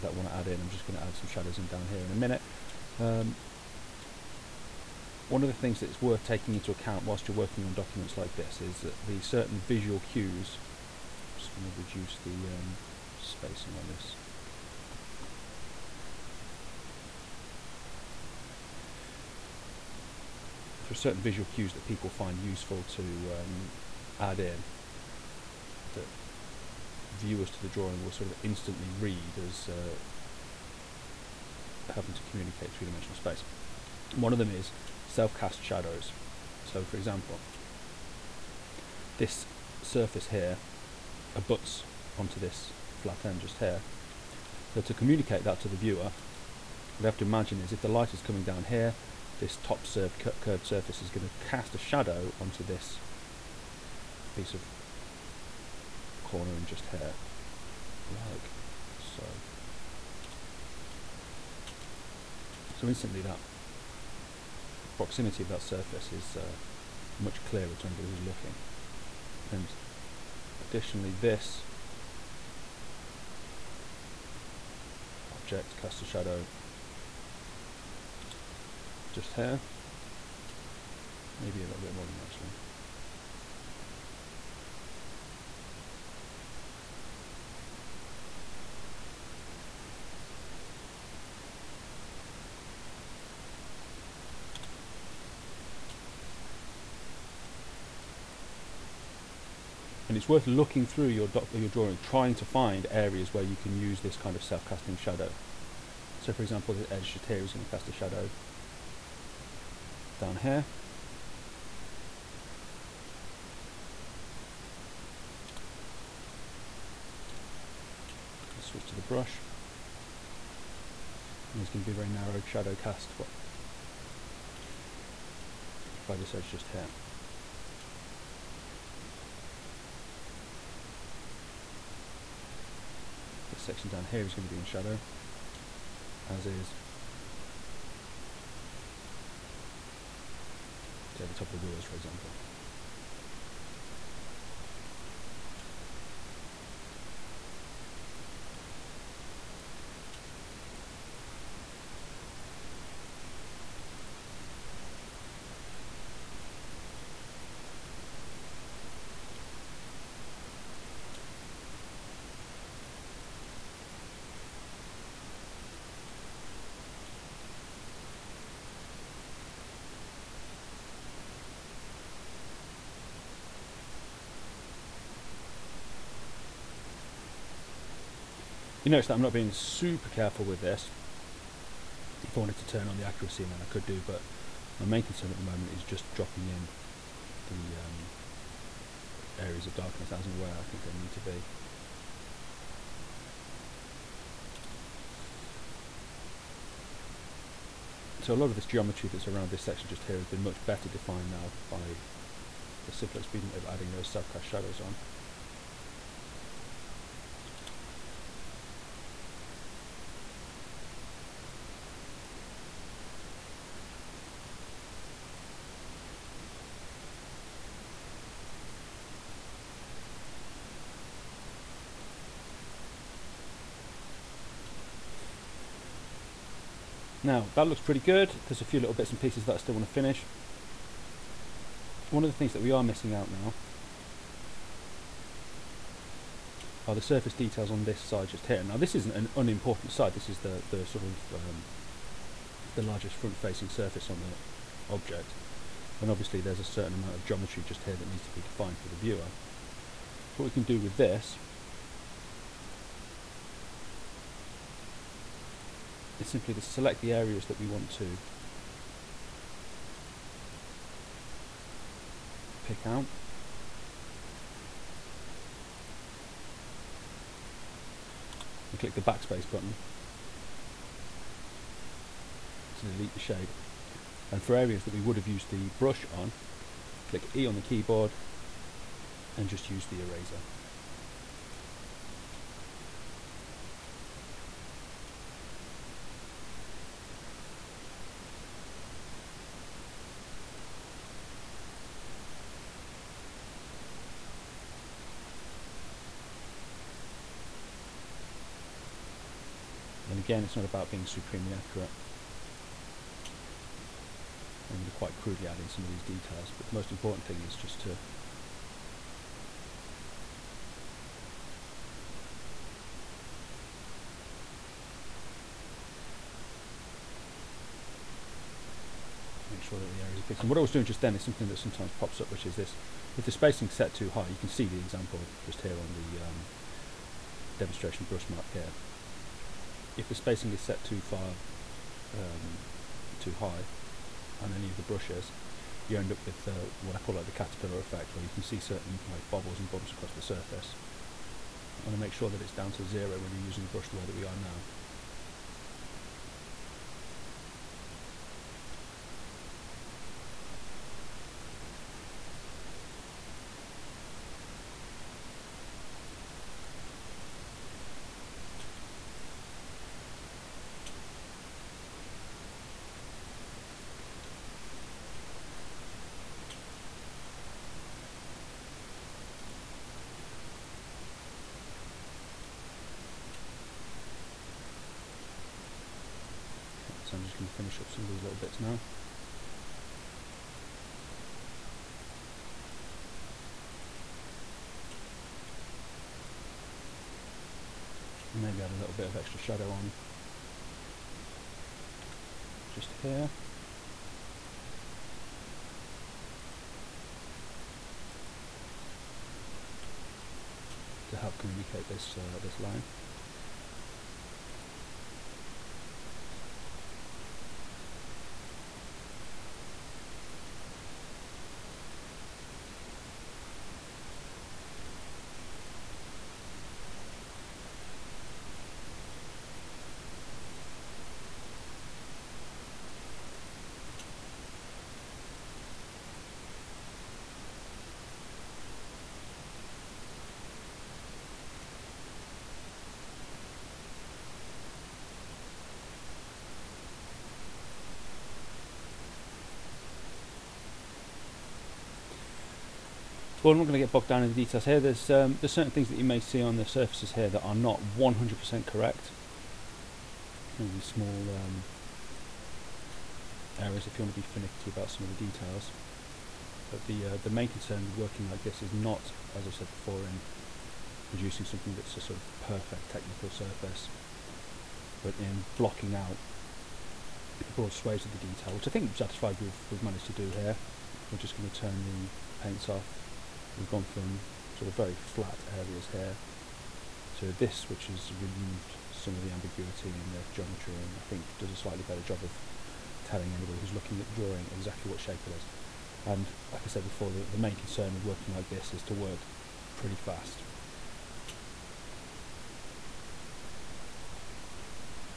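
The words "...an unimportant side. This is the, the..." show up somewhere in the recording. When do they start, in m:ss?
3:59.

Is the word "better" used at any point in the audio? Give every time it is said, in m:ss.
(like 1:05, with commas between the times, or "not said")
3:20, 8:01.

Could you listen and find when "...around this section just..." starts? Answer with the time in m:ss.
3:19.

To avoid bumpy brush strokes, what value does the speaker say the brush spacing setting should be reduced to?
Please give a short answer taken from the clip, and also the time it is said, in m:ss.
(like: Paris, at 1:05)
0, at 5:42.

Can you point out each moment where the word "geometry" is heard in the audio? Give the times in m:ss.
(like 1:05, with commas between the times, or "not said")
3:18, 4:07, 8:00.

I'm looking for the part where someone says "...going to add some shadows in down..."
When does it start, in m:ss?
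0:00.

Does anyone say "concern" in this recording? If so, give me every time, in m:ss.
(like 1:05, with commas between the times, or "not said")
3:05, 7:37, 8:07.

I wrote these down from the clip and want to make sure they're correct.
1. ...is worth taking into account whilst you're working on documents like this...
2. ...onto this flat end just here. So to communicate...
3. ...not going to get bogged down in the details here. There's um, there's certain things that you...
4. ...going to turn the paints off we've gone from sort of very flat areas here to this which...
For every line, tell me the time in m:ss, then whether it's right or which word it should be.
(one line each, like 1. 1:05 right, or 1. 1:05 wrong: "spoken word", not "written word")
1. 0:05 right
2. 0:42 right
3. 7:23 right
4. 7:51 right.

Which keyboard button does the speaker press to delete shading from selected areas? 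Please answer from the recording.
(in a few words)
Backspace.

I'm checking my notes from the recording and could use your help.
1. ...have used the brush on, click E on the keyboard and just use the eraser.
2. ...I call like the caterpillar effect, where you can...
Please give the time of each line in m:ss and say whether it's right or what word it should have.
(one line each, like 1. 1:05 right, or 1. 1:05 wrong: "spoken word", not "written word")
1. 4:35 right
2. 5:36 right.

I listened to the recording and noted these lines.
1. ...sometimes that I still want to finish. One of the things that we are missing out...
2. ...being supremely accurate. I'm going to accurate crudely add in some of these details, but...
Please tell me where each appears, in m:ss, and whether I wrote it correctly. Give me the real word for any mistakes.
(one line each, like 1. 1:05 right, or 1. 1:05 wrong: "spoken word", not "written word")
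1. 3:49 wrong: "pieces", not "sometimes"
2. 5:00 wrong: "quite", not "accurate".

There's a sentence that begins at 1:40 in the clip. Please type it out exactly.
and it's worth looking through your doc- your drawing, trying to find areas where you can use this kind of self-casting shadow.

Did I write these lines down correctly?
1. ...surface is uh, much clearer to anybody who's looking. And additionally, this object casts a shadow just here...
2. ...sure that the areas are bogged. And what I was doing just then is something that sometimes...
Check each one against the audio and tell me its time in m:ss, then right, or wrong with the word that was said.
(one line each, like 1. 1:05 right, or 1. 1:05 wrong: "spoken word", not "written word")
1. 1:05 right
2. 5:19 wrong: "picked", not "bogged".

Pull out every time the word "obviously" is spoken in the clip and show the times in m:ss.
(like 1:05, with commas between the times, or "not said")
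4:06.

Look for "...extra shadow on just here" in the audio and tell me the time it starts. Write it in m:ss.
6:29.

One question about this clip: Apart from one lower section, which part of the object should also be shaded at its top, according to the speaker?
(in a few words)
The wheels.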